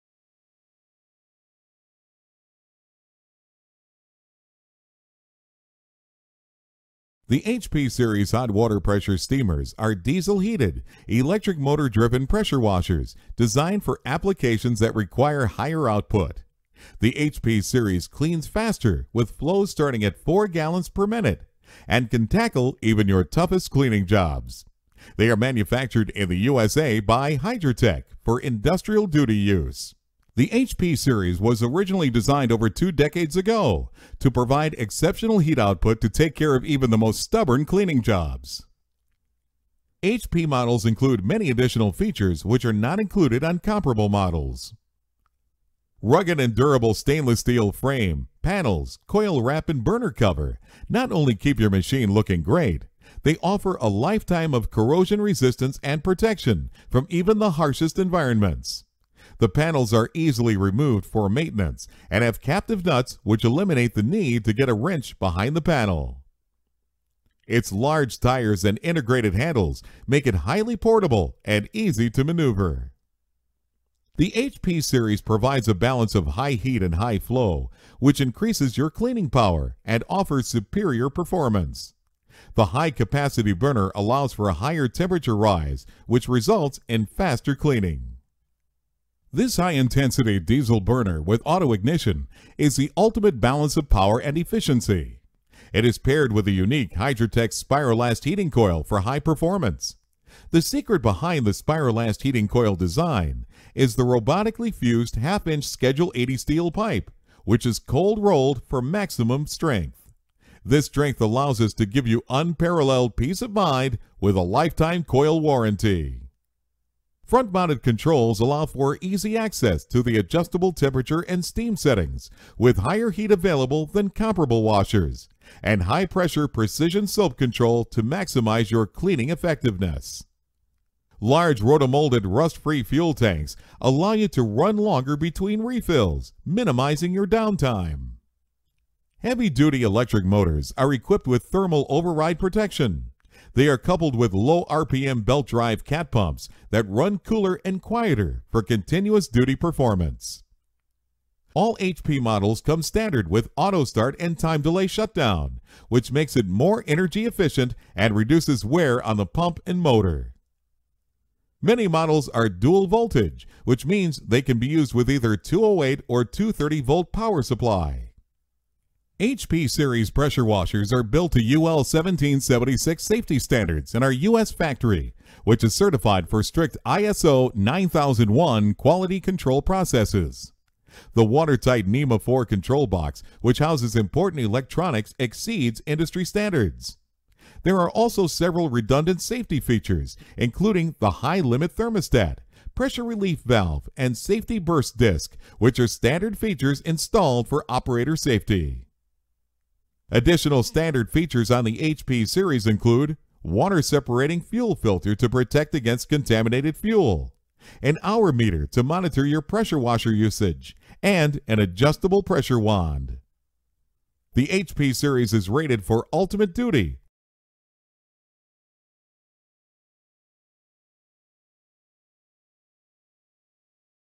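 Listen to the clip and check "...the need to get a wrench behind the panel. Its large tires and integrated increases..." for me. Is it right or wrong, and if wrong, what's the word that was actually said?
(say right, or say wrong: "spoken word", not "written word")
wrong: "handles", not "increases".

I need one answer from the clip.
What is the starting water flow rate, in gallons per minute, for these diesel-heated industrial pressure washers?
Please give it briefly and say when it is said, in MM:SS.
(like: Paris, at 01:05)
4 gallons per minute, at 00:20.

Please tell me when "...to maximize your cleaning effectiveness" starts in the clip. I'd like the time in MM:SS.
02:07.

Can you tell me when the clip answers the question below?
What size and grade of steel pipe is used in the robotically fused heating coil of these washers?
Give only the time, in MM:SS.
01:45.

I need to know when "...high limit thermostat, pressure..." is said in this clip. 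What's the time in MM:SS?
03:11.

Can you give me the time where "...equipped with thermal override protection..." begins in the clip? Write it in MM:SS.
02:20.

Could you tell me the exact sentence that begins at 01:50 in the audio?
This strength allows us to give you unparalleled peace of mind with a lifetime coil warranty.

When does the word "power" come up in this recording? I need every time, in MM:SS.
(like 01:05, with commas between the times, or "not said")
01:19, 01:33, 02:47.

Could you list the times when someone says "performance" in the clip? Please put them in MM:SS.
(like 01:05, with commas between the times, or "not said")
01:21, 01:39, 02:29.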